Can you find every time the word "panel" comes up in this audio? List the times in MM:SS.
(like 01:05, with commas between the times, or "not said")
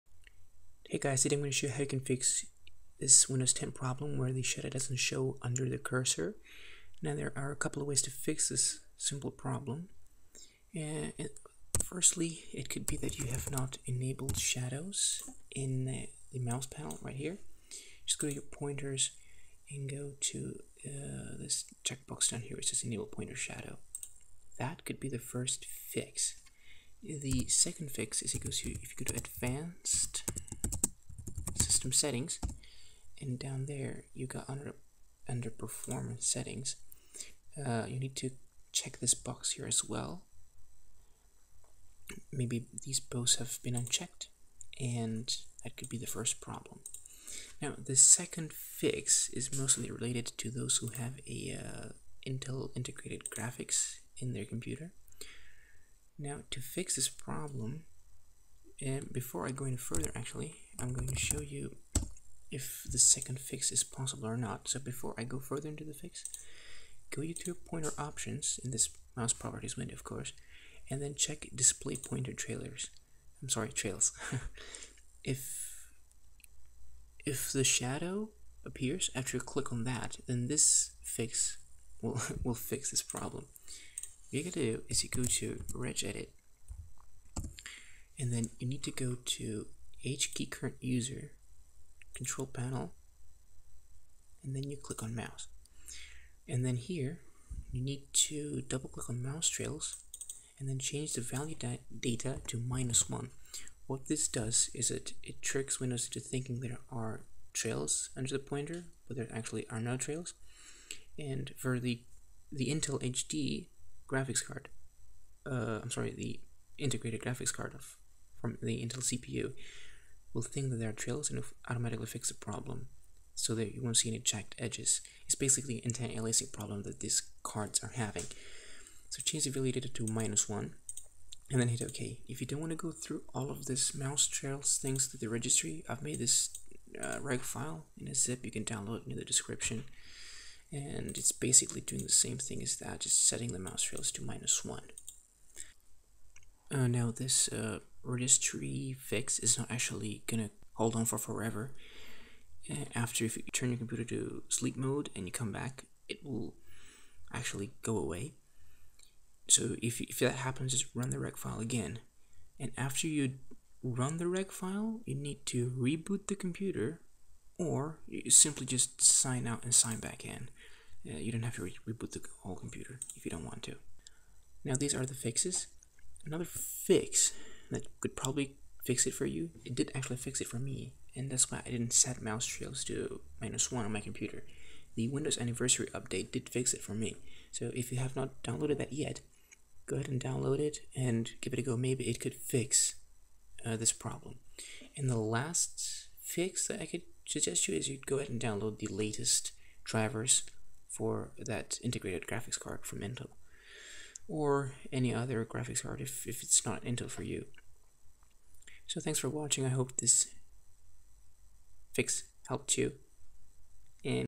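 00:16, 01:32.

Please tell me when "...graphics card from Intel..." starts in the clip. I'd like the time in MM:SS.
03:22.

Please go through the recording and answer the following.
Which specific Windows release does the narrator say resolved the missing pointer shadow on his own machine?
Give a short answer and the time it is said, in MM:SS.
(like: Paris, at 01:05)
Anniversary update, at 03:05.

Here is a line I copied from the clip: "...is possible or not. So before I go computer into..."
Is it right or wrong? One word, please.
wrong.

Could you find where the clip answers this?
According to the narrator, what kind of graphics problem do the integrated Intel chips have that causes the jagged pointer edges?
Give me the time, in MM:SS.
02:05.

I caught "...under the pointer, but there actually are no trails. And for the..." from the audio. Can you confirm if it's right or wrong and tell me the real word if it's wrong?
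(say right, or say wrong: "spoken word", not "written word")
right.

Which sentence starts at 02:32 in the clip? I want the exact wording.
Uh, after if you turn your computer to sleep mode and you come back, it will actually go away.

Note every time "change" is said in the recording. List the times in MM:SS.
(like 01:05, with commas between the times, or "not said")
01:40, 02:09.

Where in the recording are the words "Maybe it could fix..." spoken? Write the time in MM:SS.
03:11.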